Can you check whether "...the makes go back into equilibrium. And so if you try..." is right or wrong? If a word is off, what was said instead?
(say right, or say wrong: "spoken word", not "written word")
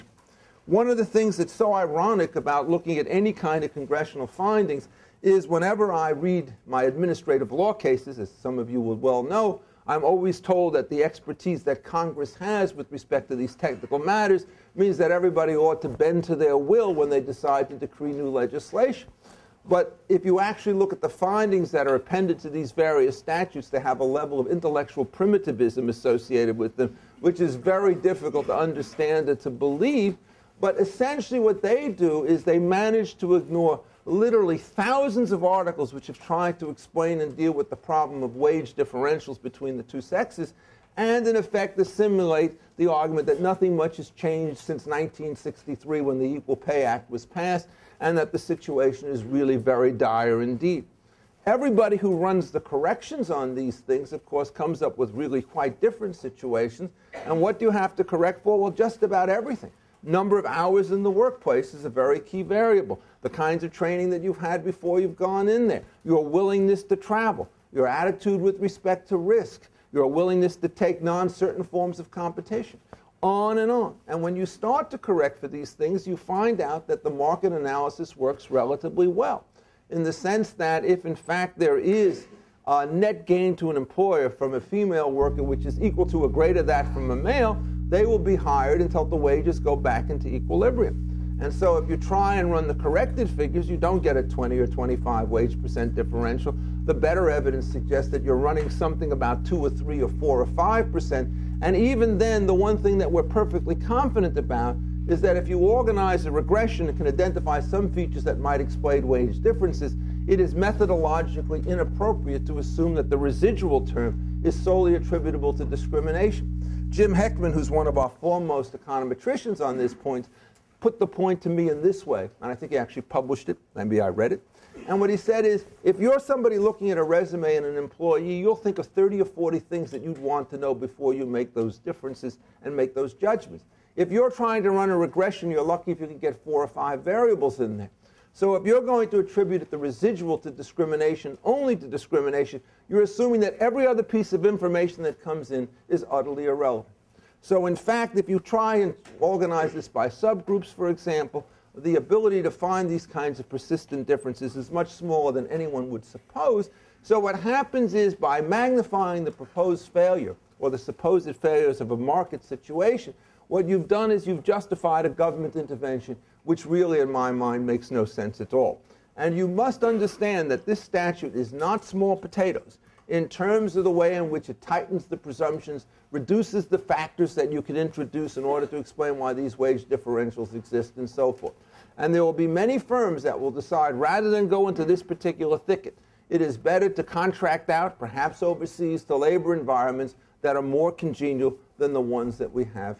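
wrong: "wages", not "makes".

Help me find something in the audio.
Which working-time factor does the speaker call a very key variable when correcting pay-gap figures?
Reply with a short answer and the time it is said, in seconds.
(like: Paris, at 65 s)
Number of hours, at 60 s.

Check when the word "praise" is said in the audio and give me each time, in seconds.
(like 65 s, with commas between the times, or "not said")
not said.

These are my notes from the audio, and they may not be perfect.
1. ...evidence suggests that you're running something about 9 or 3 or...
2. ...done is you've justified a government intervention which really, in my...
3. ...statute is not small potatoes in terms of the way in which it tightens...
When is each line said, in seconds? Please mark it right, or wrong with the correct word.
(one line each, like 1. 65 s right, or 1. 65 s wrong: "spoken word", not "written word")
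1. 97 s wrong: "2", not "9"
2. 163 s right
3. 170 s right.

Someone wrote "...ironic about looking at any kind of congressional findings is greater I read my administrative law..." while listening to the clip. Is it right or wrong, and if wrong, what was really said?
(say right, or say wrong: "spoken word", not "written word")
wrong: "whenever", not "greater".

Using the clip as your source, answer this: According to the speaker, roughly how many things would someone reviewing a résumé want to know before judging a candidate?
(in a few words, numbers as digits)
30 or 40.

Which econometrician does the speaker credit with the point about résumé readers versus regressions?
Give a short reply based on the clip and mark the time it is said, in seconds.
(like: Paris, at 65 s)
Jim Heckman, at 116 s.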